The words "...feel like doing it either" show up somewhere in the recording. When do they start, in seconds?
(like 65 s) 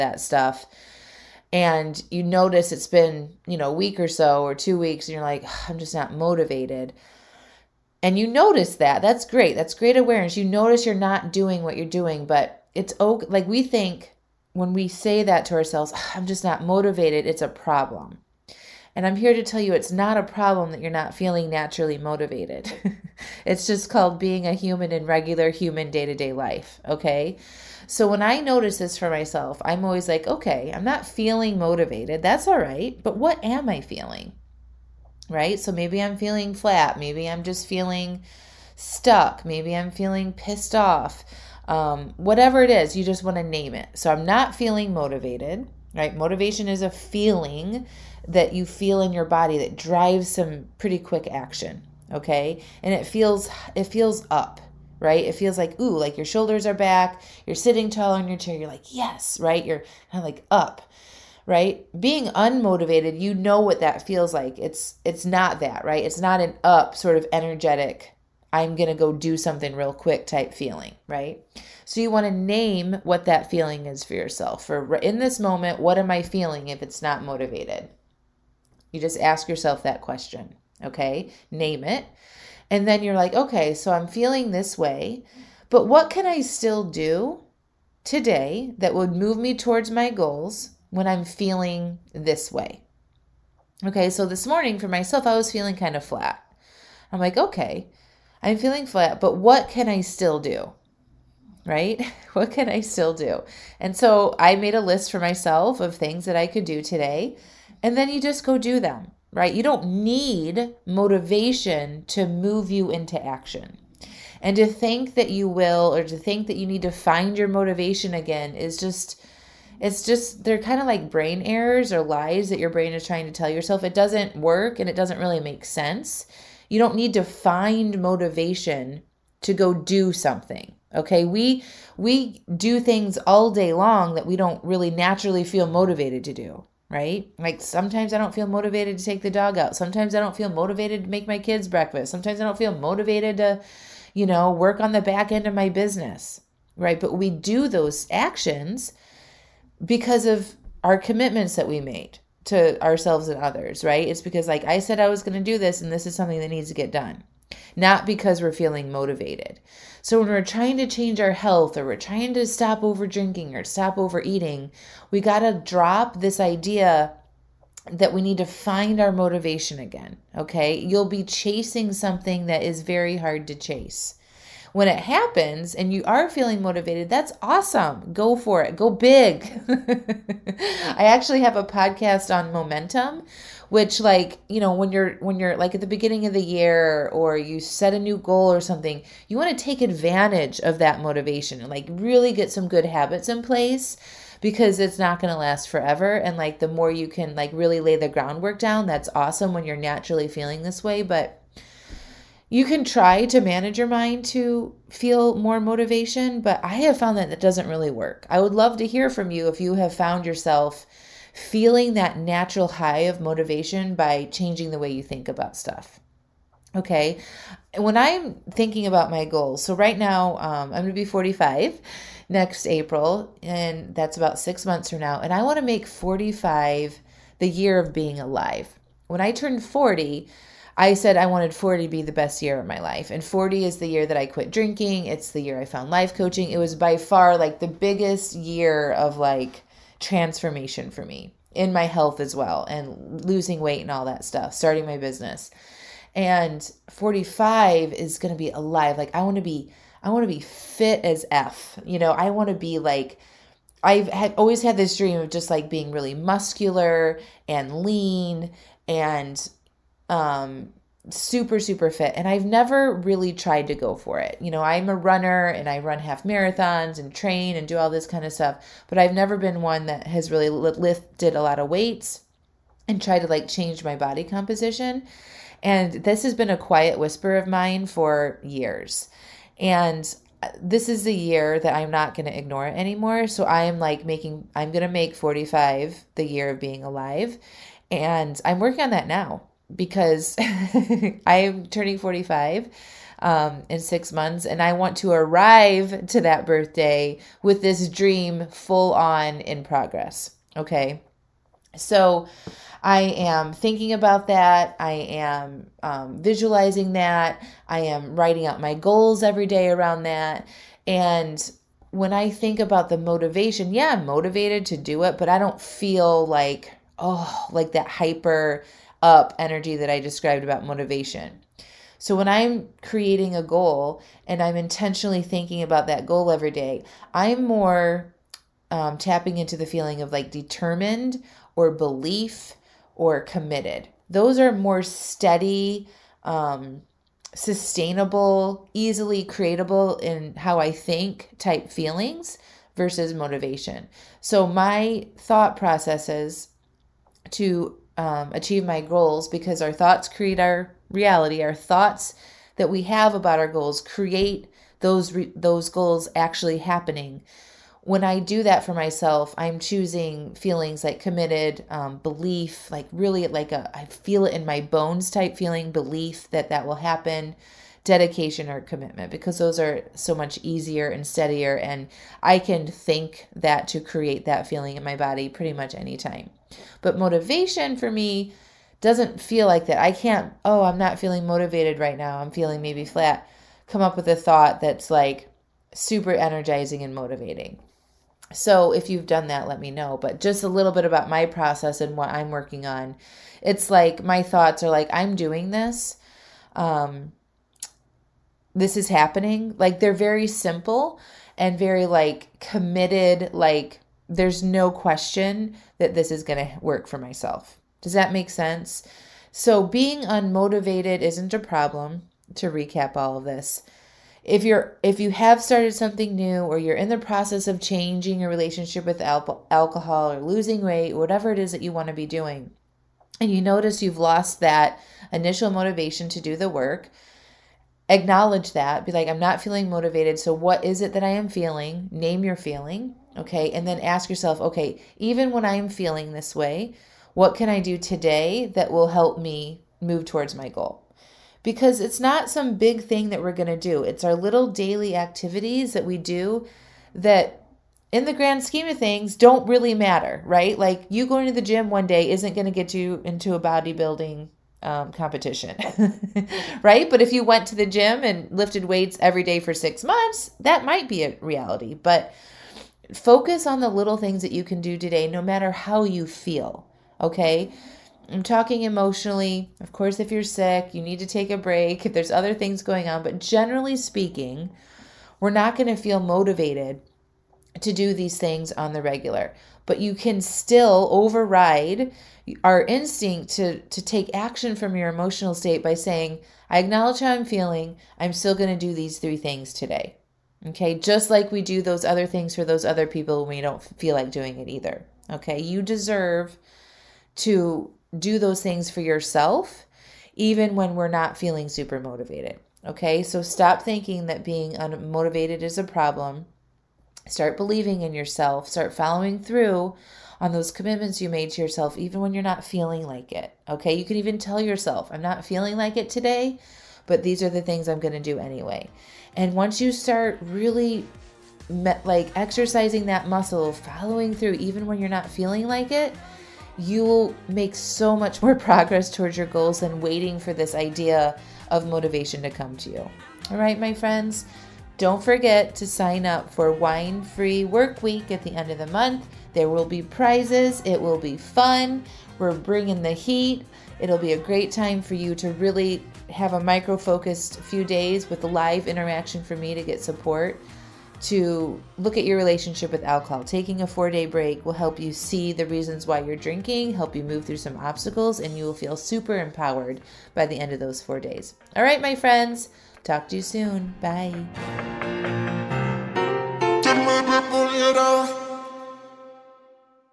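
493 s.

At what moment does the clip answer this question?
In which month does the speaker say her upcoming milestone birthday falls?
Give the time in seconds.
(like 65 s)
222 s.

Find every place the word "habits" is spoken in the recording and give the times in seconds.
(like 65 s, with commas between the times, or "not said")
192 s.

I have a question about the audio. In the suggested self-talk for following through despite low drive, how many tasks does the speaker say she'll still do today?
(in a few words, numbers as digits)
3.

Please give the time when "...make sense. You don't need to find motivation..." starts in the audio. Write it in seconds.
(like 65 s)
125 s.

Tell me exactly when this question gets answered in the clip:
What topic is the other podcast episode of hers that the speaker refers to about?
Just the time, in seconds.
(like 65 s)
182 s.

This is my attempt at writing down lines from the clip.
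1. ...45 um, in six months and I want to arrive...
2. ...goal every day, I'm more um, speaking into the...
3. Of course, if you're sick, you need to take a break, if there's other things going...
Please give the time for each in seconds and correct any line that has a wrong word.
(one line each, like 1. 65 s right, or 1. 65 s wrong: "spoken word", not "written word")
1. 291 s right
2. 326 s wrong: "tapping", not "speaking"
3. 469 s right.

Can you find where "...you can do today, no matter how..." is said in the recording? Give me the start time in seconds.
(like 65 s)
464 s.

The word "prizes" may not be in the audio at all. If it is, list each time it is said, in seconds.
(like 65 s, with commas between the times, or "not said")
539 s.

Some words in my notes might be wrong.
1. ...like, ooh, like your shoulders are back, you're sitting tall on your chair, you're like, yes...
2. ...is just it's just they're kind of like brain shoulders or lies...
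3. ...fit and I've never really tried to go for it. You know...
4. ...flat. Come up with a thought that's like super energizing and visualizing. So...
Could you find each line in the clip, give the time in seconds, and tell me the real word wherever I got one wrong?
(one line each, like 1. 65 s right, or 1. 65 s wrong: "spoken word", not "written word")
1. 55 s right
2. 118 s wrong: "errors", not "shoulders"
3. 261 s right
4. 382 s wrong: "motivating", not "visualizing".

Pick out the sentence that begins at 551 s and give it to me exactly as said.
To look at your relationship with alcohol.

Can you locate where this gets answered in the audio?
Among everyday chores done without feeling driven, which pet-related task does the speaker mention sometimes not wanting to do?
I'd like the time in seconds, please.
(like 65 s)
139 s.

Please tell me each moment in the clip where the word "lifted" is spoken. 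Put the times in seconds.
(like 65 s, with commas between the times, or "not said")
270 s, 458 s.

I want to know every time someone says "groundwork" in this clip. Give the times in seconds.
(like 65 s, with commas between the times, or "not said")
198 s.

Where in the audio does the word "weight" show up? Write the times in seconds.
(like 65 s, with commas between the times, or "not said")
243 s, 271 s, 420 s, 458 s.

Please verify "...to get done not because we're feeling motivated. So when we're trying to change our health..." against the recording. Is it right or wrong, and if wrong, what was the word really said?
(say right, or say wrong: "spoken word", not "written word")
right.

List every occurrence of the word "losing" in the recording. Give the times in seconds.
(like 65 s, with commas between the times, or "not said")
243 s, 420 s.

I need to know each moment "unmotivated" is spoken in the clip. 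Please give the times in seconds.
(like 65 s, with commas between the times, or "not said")
62 s, 410 s, 504 s.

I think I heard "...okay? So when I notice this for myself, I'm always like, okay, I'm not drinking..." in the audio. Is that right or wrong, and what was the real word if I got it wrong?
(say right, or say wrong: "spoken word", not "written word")
wrong: "feeling", not "drinking".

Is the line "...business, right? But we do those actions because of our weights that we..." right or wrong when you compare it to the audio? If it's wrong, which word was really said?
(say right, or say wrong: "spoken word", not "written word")
wrong: "commitments", not "weights".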